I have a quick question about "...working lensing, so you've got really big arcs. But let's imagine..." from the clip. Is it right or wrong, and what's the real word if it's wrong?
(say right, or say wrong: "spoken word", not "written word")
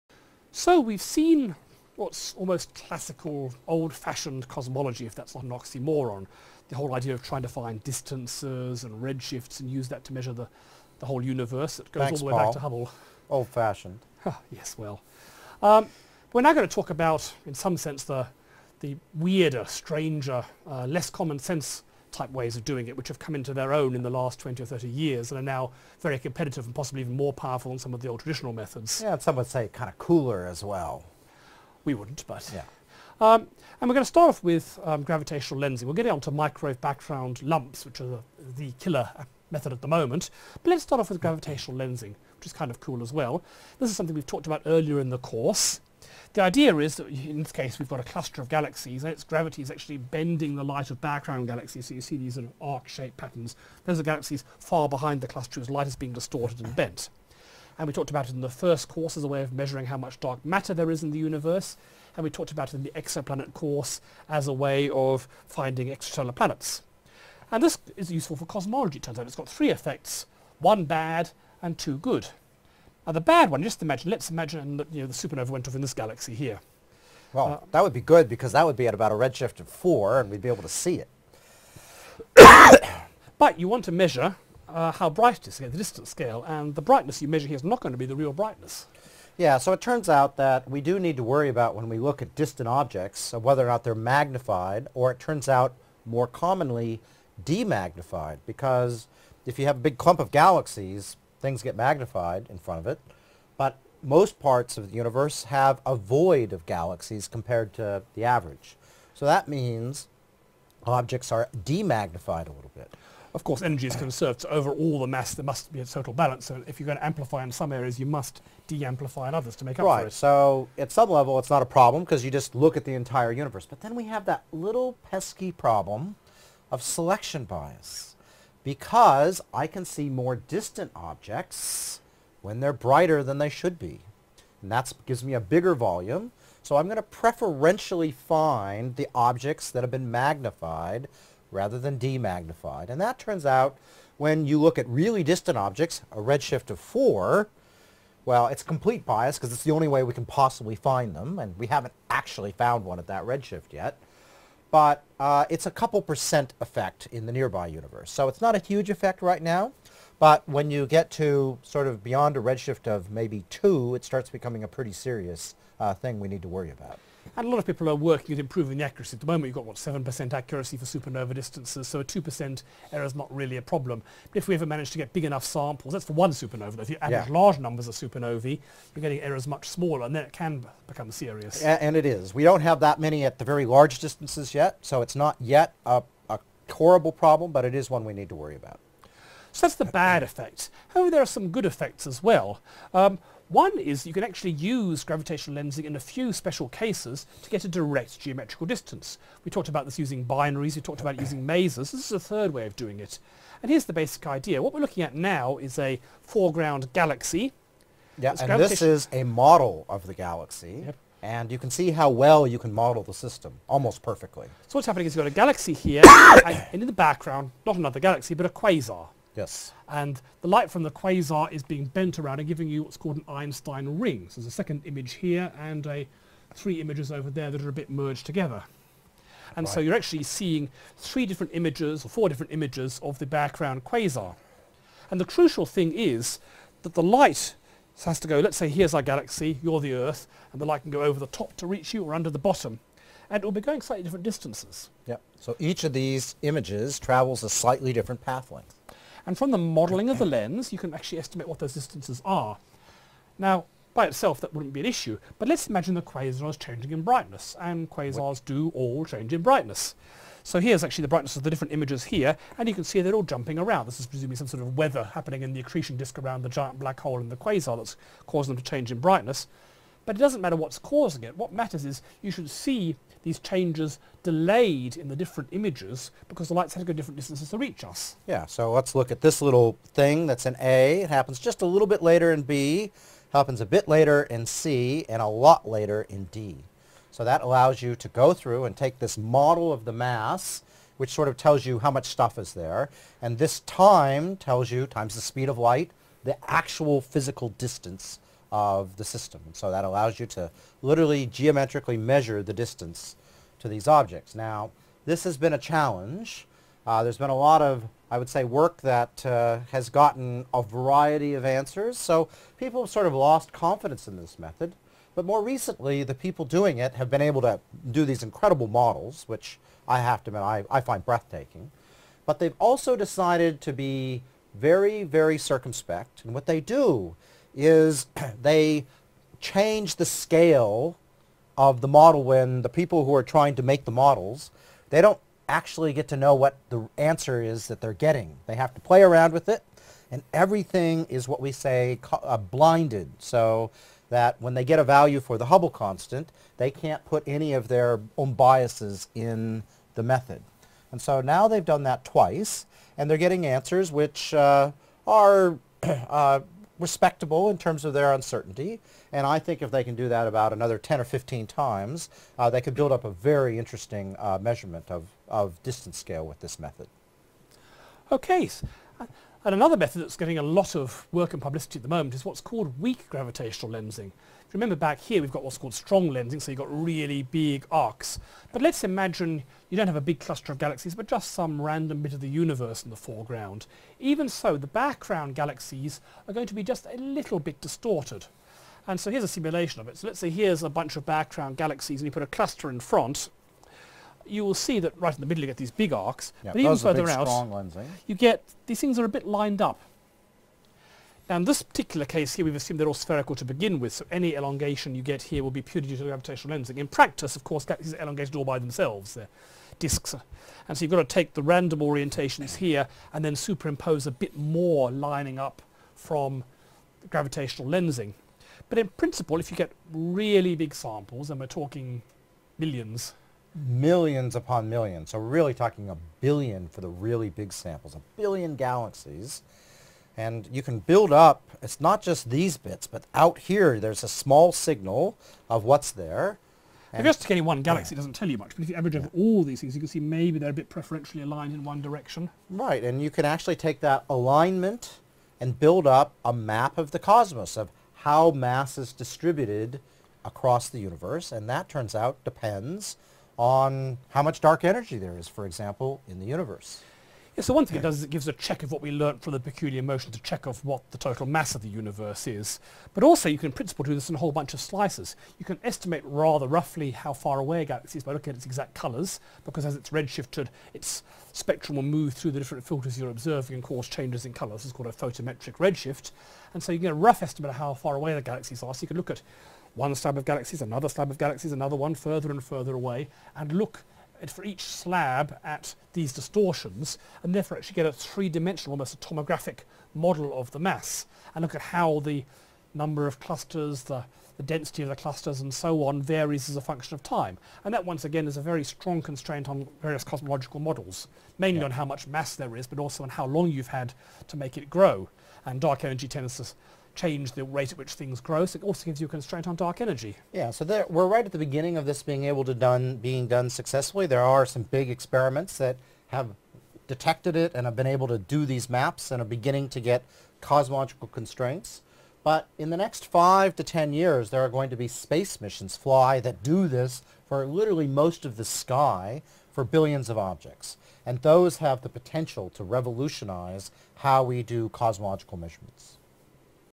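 wrong: "strong", not "working".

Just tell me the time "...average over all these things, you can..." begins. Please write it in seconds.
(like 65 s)
438 s.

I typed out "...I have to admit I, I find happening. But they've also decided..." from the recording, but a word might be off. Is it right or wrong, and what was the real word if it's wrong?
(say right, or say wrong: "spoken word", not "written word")
wrong: "breathtaking", not "happening".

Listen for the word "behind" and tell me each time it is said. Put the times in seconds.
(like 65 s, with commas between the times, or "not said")
54 s.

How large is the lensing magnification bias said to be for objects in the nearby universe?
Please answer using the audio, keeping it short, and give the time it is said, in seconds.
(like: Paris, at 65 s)
a couple percent, at 155 s.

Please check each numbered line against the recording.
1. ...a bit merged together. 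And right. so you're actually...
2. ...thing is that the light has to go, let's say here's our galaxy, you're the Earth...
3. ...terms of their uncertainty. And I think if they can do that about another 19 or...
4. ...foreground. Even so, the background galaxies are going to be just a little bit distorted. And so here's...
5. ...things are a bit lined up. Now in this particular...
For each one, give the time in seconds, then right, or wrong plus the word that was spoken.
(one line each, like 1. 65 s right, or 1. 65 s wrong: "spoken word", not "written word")
1. 227 s right
2. 235 s right
3. 357 s wrong: "10", not "19"
4. 382 s right
5. 398 s right.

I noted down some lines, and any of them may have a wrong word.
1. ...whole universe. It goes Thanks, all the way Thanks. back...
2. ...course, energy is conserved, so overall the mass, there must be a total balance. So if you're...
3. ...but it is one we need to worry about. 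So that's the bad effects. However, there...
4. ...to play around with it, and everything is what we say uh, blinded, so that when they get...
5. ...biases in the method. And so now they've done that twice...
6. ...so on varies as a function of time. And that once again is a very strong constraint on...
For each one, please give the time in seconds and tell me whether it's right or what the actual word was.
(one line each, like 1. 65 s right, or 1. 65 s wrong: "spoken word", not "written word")
1. 11 s wrong: "Paul", not "Thanks"
2. 113 s right
3. 187 s right
4. 338 s right
5. 348 s right
6. 495 s right.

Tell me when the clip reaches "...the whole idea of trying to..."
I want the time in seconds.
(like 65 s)
6 s.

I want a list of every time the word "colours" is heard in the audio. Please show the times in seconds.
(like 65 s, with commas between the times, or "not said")
468 s, 474 s.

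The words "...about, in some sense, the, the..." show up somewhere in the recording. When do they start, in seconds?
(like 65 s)
16 s.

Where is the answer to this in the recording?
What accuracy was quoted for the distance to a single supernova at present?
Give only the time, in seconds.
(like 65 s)
169 s.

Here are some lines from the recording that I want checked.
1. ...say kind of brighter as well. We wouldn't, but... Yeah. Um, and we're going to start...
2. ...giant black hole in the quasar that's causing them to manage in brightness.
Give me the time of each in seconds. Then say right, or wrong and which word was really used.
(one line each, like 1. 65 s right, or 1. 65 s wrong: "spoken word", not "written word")
1. 29 s wrong: "cooler", not "brighter"
2. 266 s wrong: "change", not "manage".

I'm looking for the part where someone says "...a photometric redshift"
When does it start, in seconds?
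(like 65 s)
474 s.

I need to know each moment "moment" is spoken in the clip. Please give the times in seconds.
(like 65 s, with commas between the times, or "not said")
39 s, 169 s, 371 s.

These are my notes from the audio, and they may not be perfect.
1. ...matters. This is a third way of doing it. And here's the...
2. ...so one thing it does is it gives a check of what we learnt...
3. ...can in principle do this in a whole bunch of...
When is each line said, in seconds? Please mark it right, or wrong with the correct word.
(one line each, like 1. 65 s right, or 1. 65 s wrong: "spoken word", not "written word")
1. 201 s wrong: "masers", not "matters"
2. 457 s right
3. 463 s right.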